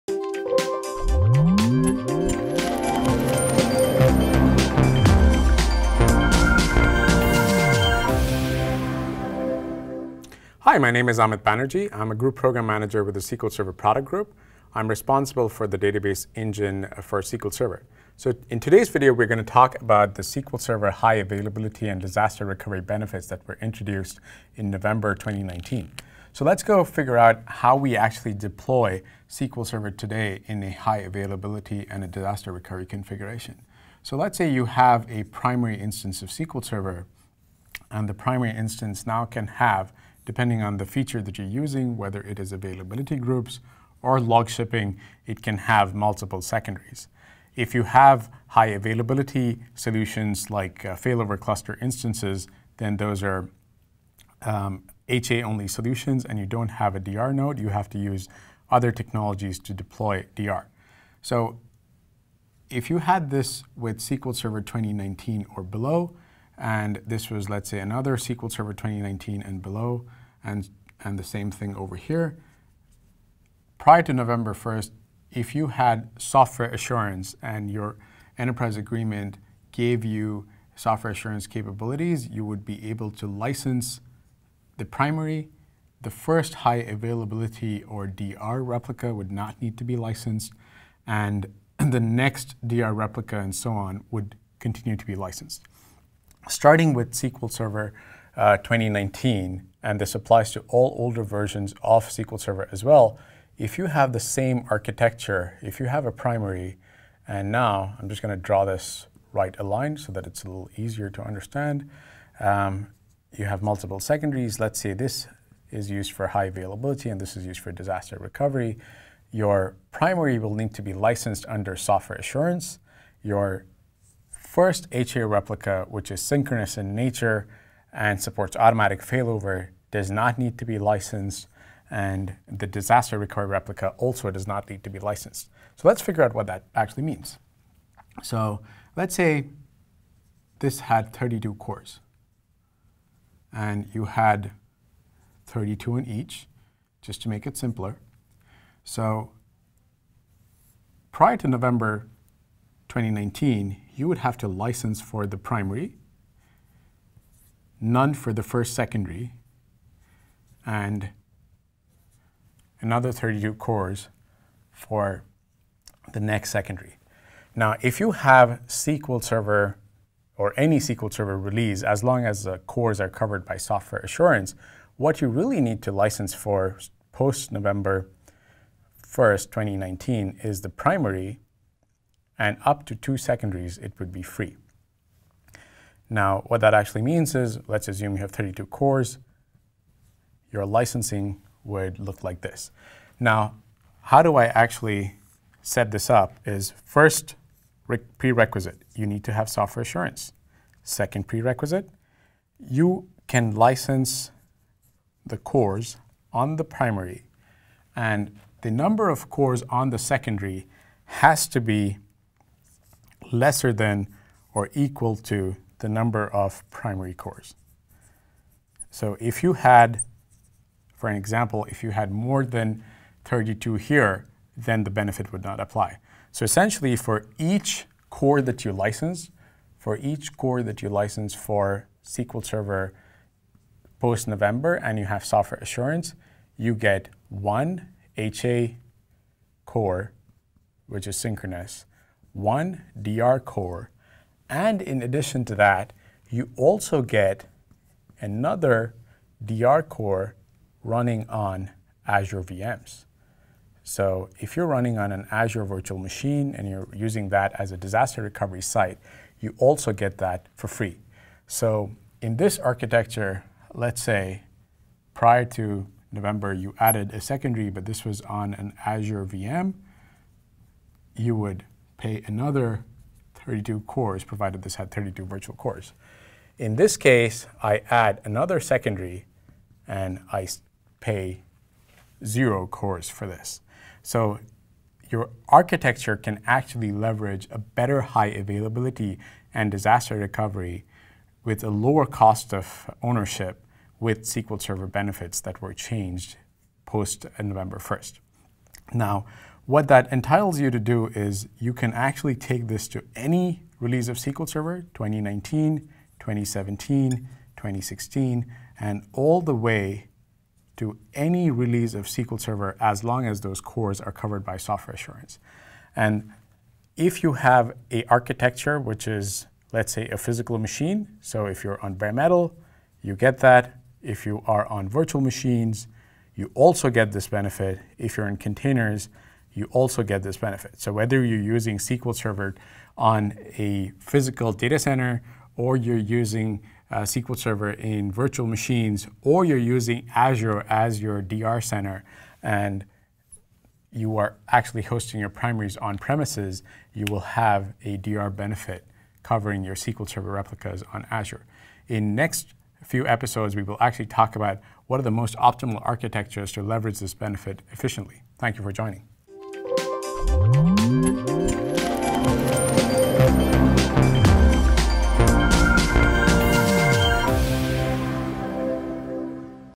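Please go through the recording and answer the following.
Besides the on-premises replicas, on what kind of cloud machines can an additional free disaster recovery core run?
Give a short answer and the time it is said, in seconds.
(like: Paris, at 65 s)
Azure VMs, at 252 s.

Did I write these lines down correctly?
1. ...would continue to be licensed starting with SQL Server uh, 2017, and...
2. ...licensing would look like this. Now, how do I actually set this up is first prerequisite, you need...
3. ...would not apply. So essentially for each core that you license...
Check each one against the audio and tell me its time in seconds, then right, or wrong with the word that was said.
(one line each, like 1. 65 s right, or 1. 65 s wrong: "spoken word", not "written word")
1. 94 s wrong: "2019", not "2017"
2. 190 s right
3. 225 s right.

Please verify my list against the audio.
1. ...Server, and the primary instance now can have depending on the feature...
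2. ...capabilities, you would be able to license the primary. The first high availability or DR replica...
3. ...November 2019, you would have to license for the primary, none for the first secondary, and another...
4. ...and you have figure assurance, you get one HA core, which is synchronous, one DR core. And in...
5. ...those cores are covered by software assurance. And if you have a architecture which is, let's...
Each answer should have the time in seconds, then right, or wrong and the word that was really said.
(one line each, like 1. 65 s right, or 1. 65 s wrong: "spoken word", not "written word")
1. 36 s right
2. 81 s right
3. 151 s right
4. 234 s wrong: "software", not "figure"
5. 313 s right.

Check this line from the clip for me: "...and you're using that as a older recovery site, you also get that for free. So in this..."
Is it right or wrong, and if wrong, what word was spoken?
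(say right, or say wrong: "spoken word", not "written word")
wrong: "disaster", not "older".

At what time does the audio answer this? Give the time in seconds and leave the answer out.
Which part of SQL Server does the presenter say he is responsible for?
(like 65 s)
15 s.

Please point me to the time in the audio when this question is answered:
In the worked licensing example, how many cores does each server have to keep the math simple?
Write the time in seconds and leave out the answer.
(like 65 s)
141 s.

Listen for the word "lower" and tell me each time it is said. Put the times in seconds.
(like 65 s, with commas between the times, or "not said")
291 s.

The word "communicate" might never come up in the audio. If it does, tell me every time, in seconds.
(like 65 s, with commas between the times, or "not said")
not said.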